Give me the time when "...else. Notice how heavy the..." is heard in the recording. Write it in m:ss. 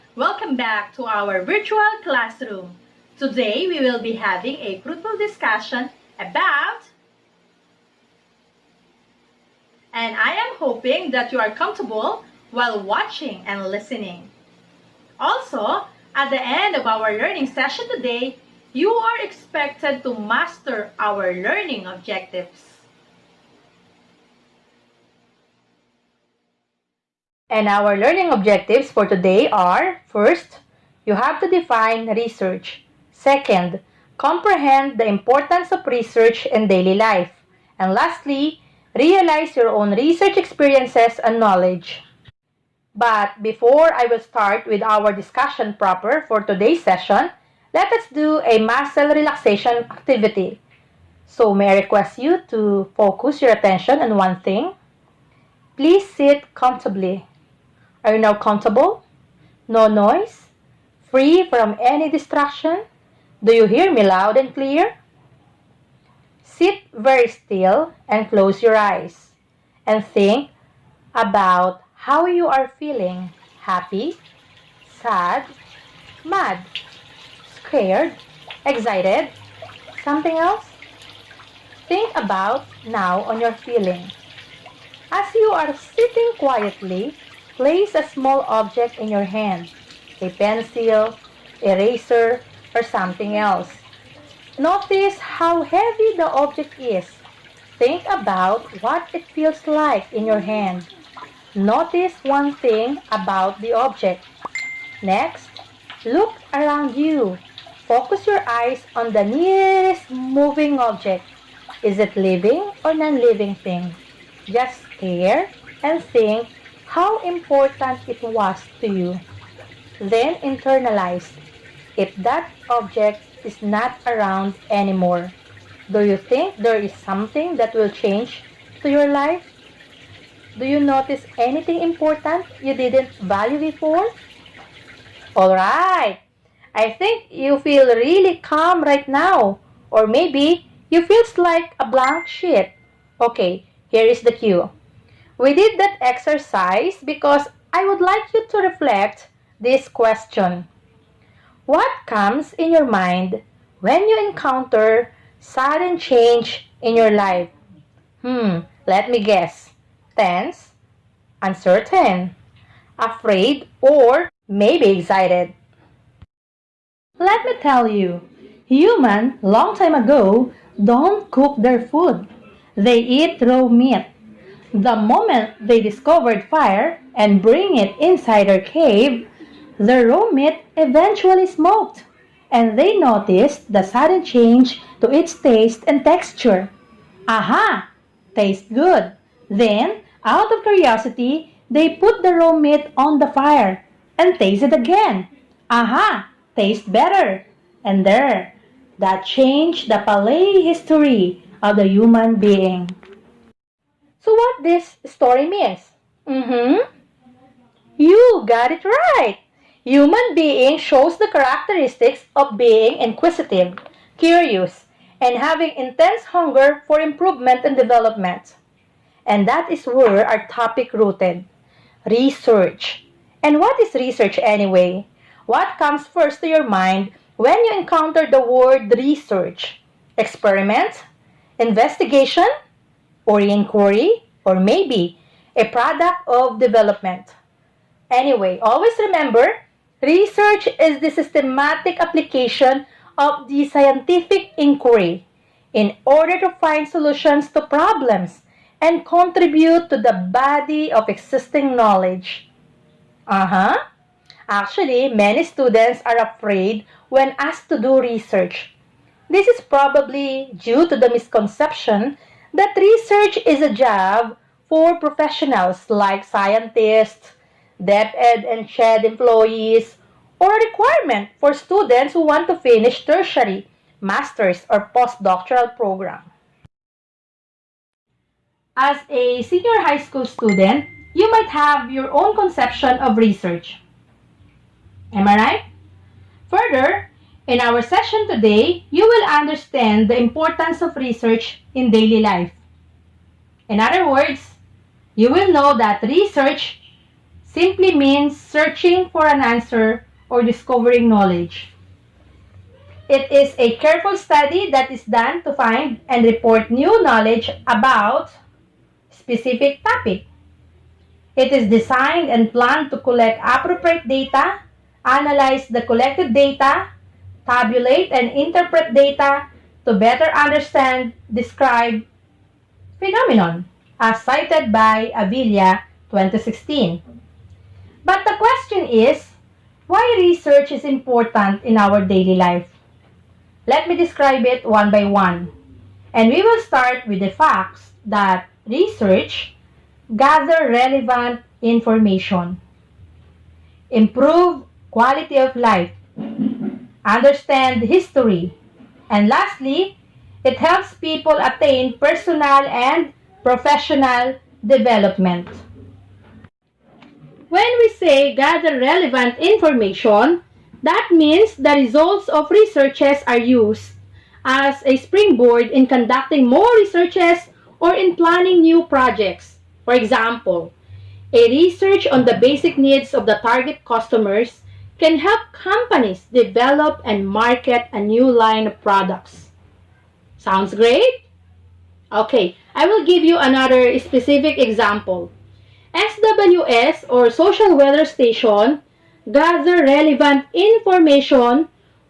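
1:33.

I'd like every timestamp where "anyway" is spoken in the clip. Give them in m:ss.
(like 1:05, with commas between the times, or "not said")
3:44, 3:58.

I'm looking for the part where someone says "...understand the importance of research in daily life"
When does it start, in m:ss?
4:49.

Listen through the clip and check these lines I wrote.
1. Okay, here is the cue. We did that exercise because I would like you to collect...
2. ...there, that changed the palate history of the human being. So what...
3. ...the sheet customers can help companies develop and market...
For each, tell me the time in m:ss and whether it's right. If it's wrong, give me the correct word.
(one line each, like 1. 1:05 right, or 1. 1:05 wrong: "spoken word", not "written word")
1. 2:23 wrong: "reflect", not "collect"
2. 3:18 right
3. 6:13 wrong: "target", not "sheet".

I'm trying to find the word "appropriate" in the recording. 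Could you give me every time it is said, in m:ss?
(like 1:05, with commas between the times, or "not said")
5:13.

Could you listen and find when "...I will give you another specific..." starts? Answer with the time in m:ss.
6:22.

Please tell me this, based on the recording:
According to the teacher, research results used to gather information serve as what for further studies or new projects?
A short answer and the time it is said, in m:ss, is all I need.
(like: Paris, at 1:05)
springboard, at 6:04.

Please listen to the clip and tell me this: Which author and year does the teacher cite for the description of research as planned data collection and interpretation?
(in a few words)
Avilia 2016.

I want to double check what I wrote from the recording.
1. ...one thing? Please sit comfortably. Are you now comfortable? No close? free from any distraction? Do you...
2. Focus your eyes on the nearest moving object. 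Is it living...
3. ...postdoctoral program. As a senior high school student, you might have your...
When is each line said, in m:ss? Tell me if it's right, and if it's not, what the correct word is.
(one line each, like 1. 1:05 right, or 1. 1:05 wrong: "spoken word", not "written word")
1. 0:54 wrong: "noise", not "close"
2. 1:47 right
3. 4:34 right.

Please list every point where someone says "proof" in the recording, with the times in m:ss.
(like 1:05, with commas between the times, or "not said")
not said.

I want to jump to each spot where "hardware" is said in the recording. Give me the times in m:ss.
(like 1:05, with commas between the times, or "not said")
not said.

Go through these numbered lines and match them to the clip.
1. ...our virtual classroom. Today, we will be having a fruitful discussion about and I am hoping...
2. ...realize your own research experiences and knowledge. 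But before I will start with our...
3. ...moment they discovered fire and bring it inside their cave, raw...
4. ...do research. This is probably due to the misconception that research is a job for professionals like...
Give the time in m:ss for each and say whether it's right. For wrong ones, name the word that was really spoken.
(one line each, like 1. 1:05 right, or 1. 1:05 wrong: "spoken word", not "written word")
1. 0:01 right
2. 0:38 right
3. 2:54 right
4. 4:17 right.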